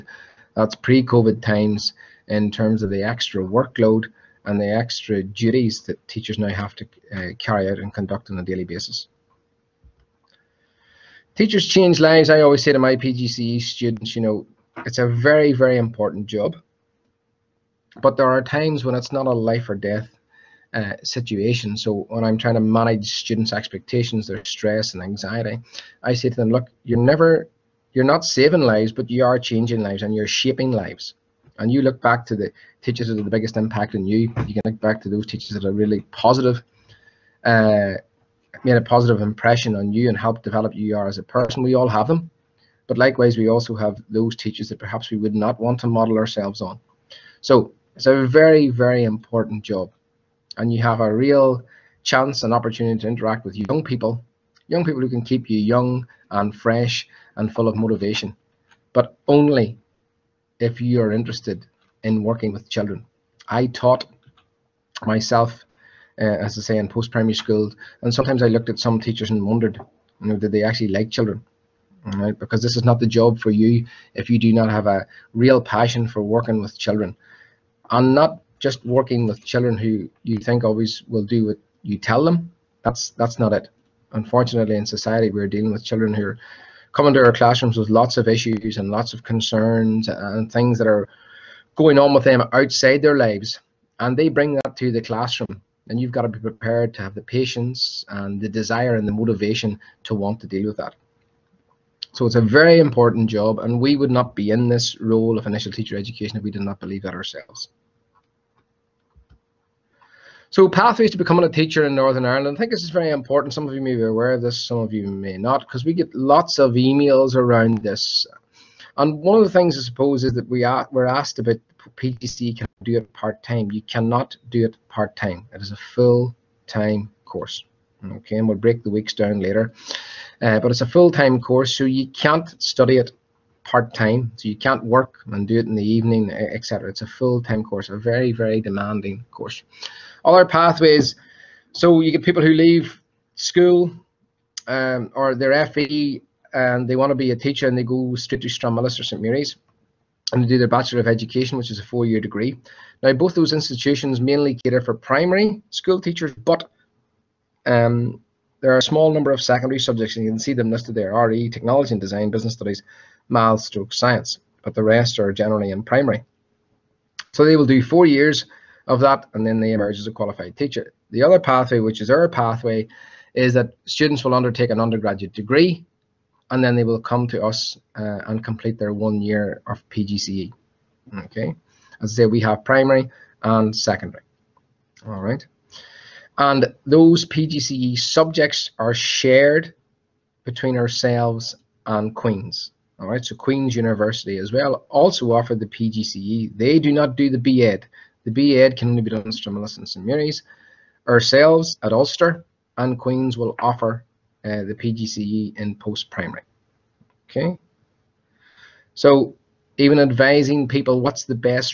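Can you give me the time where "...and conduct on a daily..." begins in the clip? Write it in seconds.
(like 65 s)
7 s.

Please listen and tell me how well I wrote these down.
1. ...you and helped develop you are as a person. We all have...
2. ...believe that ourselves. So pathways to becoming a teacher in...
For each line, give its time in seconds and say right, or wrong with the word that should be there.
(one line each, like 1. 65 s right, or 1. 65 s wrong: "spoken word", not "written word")
1. 39 s right
2. 106 s right.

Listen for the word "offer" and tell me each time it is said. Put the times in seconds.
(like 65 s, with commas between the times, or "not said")
195 s, 203 s.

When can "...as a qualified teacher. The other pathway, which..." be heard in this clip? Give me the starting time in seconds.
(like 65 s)
169 s.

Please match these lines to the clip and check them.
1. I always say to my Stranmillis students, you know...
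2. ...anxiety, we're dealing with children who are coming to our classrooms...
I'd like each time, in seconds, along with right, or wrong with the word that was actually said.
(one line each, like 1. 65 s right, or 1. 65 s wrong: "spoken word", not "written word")
1. 12 s wrong: "PGCE", not "Stranmillis"
2. 84 s wrong: "society", not "anxiety".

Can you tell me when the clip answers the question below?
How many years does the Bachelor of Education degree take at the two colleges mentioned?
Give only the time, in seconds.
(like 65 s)
151 s.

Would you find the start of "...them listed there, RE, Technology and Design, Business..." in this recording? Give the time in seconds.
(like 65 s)
160 s.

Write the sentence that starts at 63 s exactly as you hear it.
I taught myself uh, as I say, in post-primary school.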